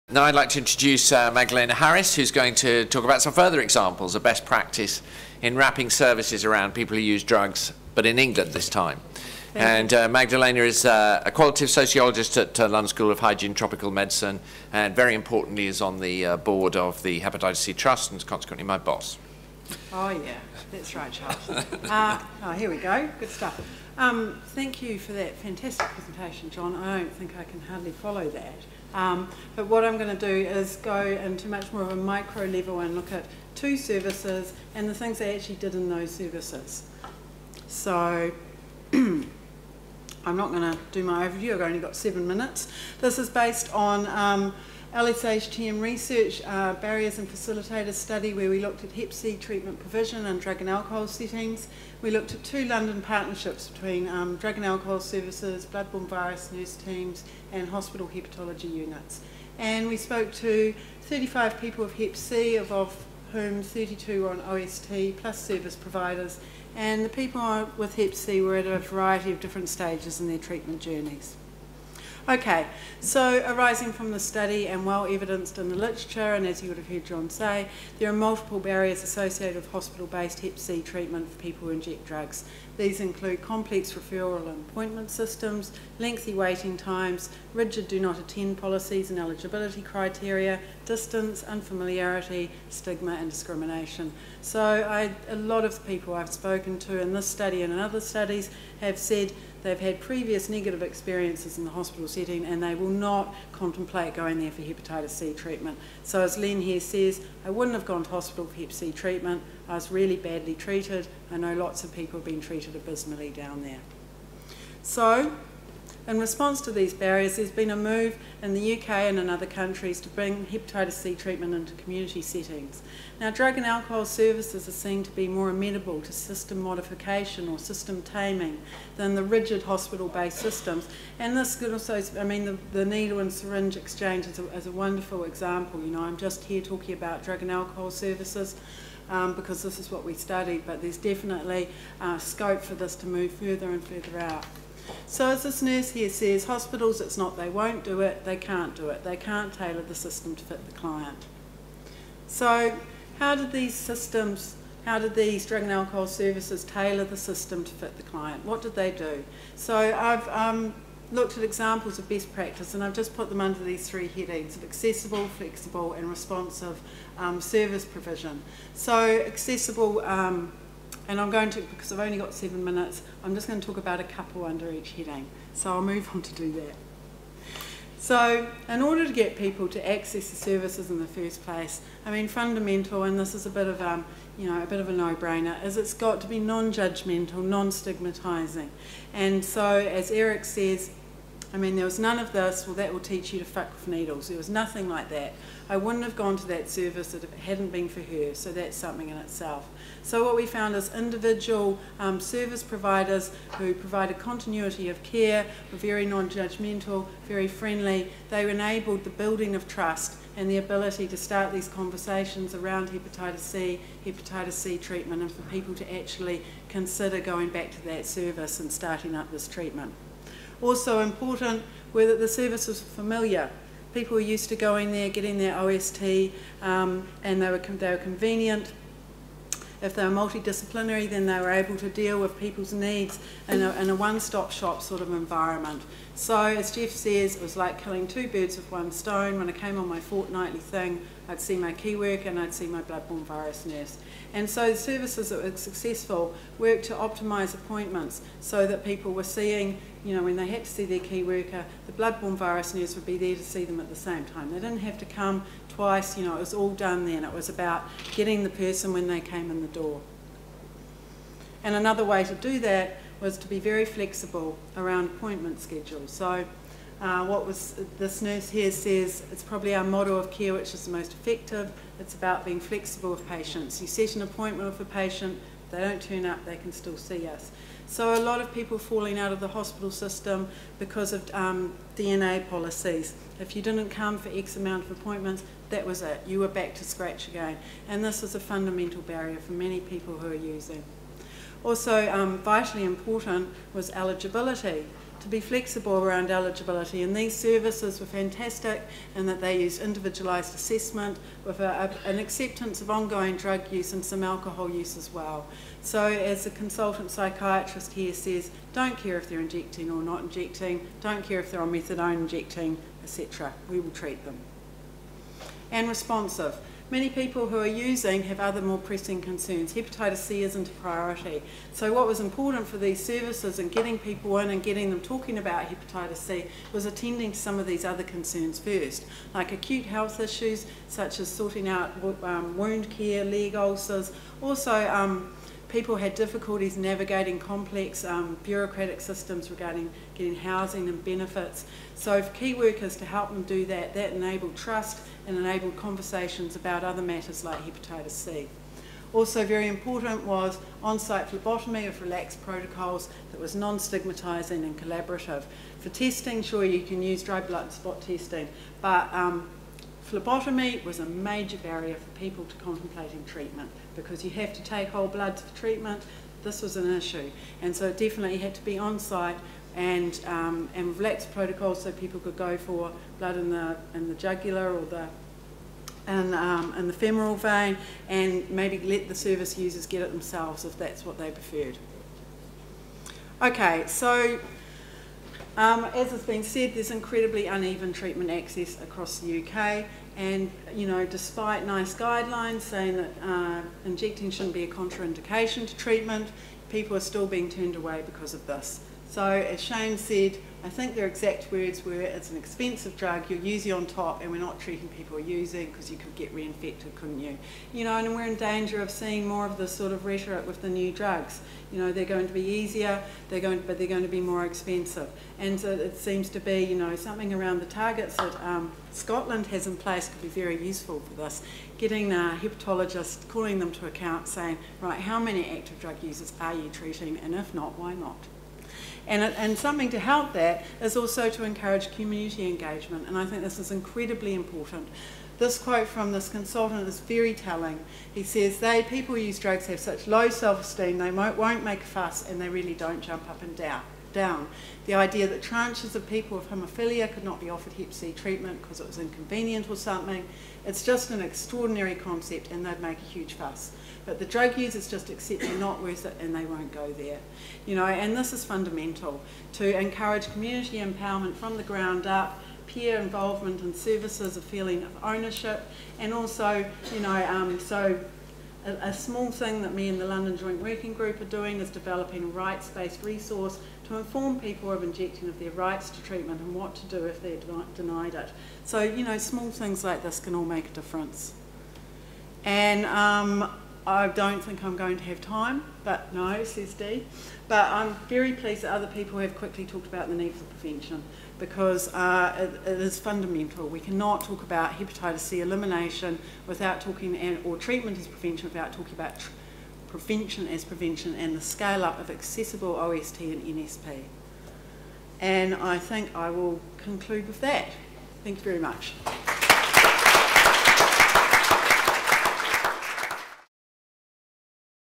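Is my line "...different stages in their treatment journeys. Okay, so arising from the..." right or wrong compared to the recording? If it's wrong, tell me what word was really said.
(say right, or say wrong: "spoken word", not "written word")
right.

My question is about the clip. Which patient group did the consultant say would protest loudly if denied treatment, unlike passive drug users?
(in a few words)
people with haemophilia.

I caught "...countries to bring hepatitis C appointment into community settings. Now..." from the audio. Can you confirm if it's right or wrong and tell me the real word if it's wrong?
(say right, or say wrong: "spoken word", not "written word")
wrong: "treatment", not "appointment".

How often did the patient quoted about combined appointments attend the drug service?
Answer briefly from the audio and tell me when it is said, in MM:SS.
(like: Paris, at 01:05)
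fortnightly, at 03:59.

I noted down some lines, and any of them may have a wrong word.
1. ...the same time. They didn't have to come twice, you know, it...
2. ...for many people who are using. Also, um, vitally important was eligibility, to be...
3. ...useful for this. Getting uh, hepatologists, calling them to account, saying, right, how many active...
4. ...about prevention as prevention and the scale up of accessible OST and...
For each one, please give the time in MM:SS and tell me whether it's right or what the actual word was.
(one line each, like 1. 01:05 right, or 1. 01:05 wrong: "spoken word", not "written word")
1. 04:13 right
2. 04:49 right
3. 07:00 right
4. 08:18 right.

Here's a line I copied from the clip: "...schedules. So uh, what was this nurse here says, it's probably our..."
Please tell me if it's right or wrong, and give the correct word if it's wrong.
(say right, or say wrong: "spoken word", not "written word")
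right.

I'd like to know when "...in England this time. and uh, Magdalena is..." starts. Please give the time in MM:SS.
00:08.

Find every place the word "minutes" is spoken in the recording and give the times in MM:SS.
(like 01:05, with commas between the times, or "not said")
00:42, 02:52.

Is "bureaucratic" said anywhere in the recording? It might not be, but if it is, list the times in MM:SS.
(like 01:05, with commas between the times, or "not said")
05:38.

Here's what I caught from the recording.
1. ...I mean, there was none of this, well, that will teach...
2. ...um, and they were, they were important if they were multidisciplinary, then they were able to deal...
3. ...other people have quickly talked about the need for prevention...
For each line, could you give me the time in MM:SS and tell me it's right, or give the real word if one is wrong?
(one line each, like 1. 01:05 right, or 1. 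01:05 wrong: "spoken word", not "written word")
1. 03:11 right
2. 03:46 wrong: "convenient", not "important"
3. 08:08 right.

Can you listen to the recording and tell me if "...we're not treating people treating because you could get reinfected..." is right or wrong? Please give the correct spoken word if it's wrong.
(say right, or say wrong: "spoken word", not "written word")
wrong: "using", not "treating".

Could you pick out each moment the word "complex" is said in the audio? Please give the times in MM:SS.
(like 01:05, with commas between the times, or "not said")
01:23, 05:37.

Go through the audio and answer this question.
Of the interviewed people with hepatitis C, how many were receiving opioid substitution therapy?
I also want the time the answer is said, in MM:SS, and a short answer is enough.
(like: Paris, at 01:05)
32, at 01:03.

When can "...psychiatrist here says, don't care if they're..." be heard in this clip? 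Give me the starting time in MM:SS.
05:07.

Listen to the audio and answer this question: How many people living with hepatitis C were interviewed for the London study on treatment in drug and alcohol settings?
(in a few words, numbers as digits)
35.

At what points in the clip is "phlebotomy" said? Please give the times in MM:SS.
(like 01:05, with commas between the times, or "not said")
05:51, 06:00.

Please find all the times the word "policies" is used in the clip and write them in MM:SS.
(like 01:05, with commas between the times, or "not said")
01:28, 04:42.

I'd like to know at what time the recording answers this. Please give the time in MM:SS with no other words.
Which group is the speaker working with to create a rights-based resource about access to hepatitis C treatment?
07:50.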